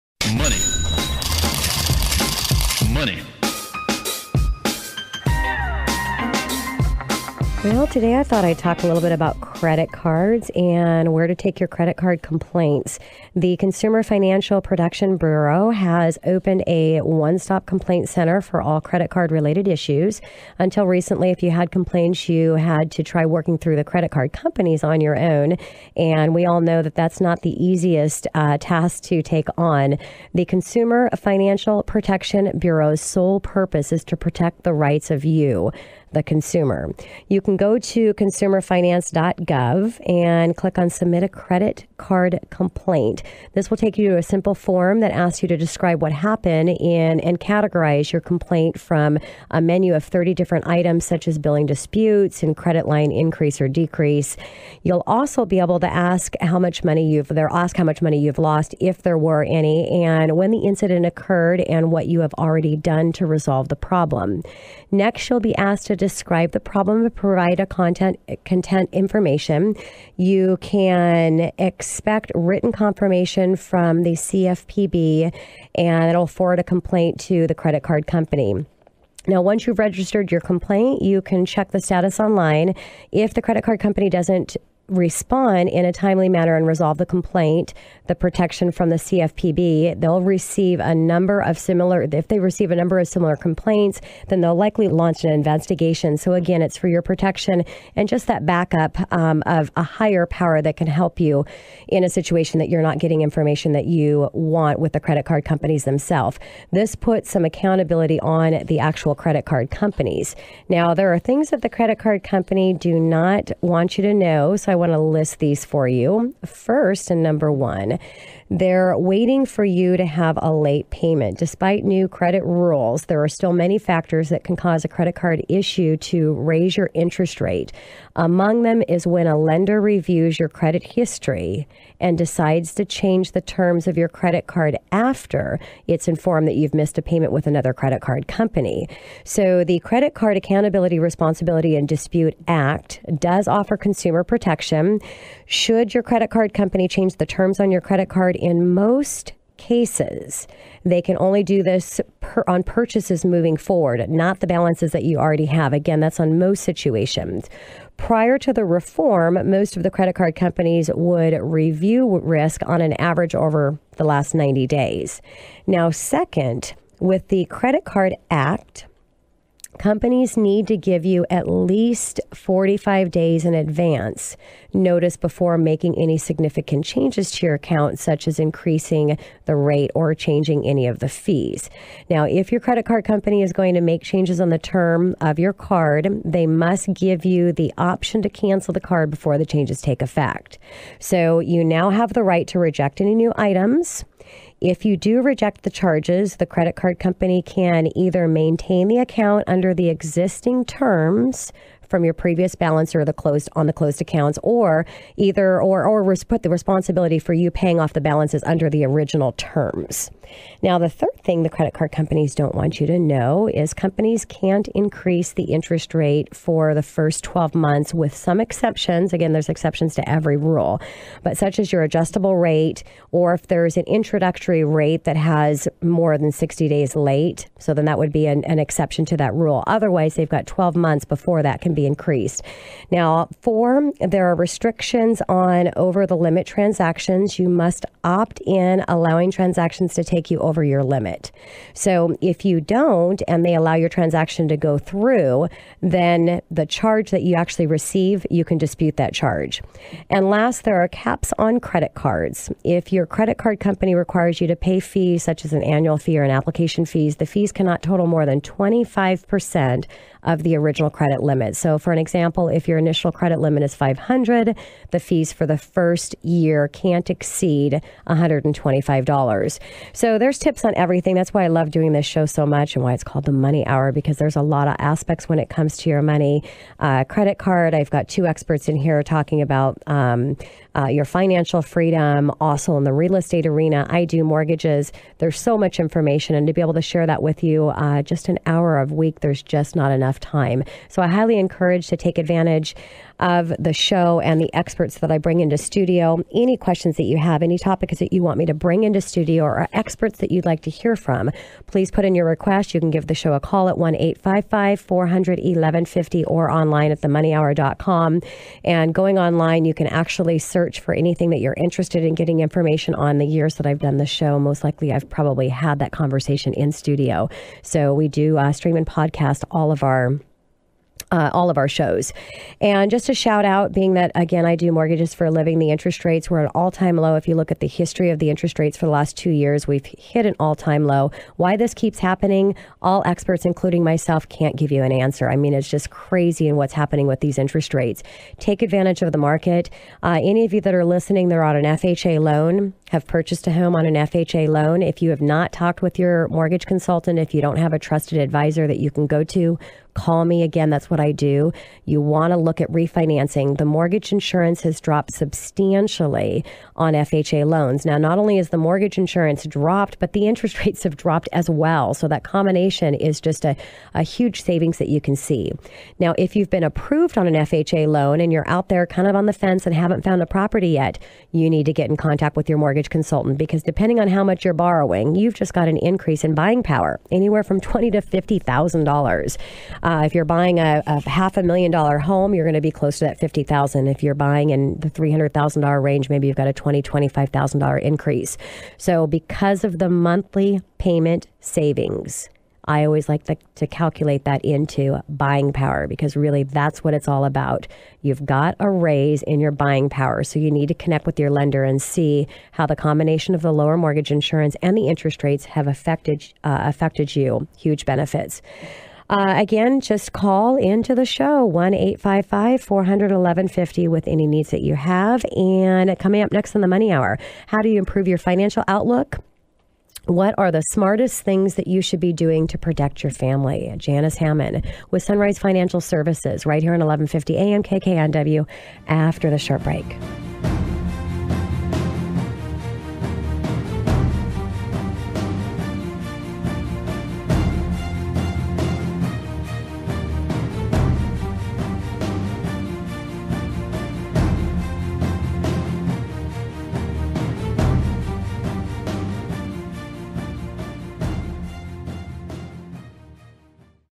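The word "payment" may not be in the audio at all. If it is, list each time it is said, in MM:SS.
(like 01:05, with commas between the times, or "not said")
02:00, 02:17, 06:30.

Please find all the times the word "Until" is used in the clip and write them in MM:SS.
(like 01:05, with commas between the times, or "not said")
00:20.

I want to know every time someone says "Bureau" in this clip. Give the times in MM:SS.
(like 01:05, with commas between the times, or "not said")
00:15, 00:32.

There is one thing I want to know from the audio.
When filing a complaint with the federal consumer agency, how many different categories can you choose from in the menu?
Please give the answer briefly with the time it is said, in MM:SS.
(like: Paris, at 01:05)
30, at 00:50.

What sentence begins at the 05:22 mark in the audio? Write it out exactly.
And just a shout out, being that, again, I do mortgages for a living, the interest rates were an all time low.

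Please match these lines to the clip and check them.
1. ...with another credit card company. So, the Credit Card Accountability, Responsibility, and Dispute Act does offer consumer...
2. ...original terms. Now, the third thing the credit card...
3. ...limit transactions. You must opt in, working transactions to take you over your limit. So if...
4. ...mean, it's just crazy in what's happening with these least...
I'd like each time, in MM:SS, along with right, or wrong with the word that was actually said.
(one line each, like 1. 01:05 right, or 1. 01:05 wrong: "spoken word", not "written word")
1. 02:17 right
2. 03:28 right
3. 03:56 wrong: "allowing", not "working"
4. 05:35 wrong: "interest", not "least".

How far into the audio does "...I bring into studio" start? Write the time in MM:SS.
04:55.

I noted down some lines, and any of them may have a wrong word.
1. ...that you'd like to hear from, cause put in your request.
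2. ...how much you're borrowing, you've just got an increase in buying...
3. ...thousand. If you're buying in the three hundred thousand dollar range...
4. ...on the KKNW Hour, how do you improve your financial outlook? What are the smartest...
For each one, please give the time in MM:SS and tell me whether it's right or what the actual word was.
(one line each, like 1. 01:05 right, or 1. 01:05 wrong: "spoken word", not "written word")
1. 05:00 wrong: "please", not "cause"
2. 06:14 right
3. 06:23 right
4. 06:56 wrong: "Money", not "KKNW".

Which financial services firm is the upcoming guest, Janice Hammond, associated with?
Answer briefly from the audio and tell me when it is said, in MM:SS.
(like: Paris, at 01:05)
Sunrise Financial Services, at 07:05.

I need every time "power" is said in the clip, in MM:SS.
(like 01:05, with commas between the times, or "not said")
01:40, 06:16, 06:35, 06:39.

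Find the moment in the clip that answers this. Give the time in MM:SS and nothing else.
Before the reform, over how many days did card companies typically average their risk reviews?
02:44.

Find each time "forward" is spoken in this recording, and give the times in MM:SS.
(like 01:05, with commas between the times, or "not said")
01:16, 02:33.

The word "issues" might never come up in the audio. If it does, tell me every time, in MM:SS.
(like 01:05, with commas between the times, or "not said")
00:19, 02:05.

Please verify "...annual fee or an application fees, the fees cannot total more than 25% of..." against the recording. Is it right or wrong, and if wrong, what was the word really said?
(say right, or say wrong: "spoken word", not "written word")
right.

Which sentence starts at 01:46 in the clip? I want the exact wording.
This puts some accountability on the actual credit card companies.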